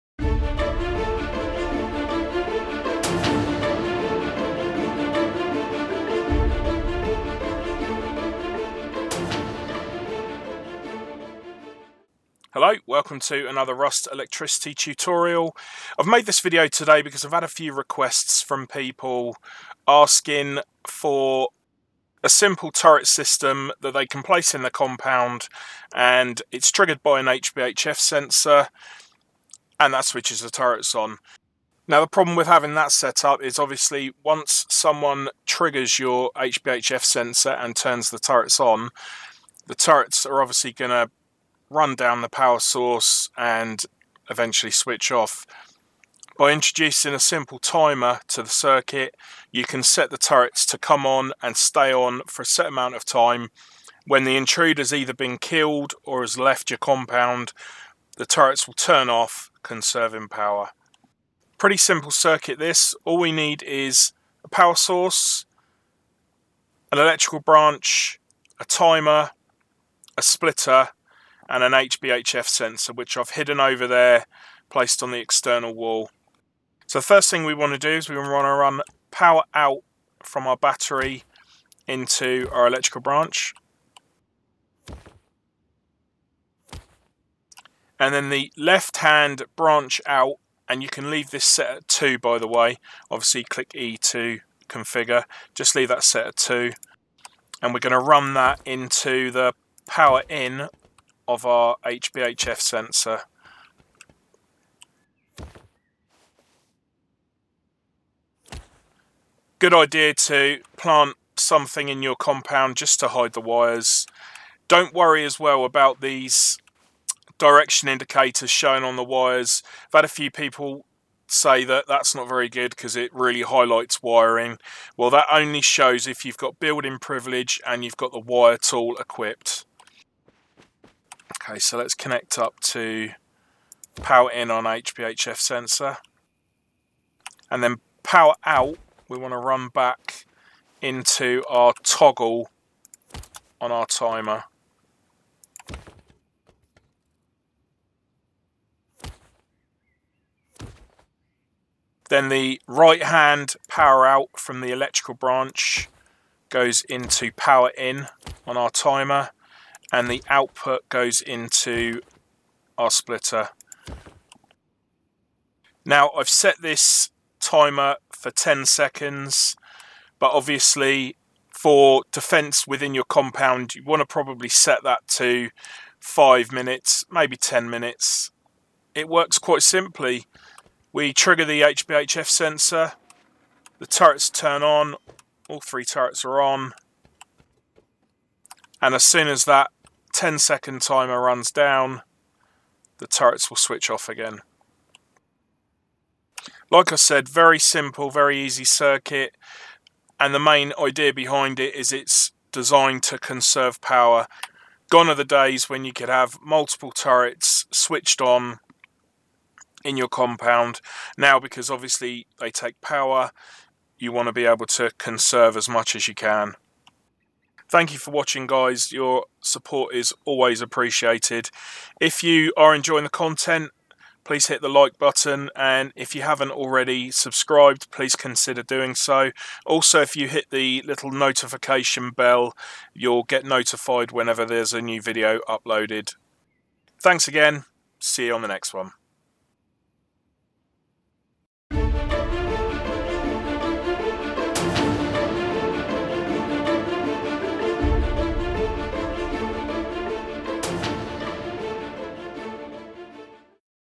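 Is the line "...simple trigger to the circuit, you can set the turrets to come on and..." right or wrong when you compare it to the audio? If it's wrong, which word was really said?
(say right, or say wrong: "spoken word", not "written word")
wrong: "timer", not "trigger".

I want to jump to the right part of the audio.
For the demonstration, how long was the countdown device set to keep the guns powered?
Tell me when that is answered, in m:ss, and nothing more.
2:48.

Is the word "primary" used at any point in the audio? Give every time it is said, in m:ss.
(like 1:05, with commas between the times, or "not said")
not said.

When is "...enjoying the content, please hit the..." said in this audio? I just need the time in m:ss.
3:42.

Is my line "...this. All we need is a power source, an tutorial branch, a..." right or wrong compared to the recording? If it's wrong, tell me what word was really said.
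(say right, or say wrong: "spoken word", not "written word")
wrong: "electrical", not "tutorial".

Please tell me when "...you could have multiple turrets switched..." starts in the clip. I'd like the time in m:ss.
3:25.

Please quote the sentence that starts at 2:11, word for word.
Okay, so let's connect up to power in on HBHF sensor.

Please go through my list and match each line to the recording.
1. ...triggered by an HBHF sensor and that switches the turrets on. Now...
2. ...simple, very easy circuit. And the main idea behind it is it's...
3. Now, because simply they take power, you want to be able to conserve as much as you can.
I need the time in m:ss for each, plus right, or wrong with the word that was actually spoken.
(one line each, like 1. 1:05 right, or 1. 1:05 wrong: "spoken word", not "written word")
1. 0:26 right
2. 3:17 right
3. 3:31 wrong: "obviously", not "simply".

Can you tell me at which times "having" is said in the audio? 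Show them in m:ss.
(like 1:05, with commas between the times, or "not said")
0:32.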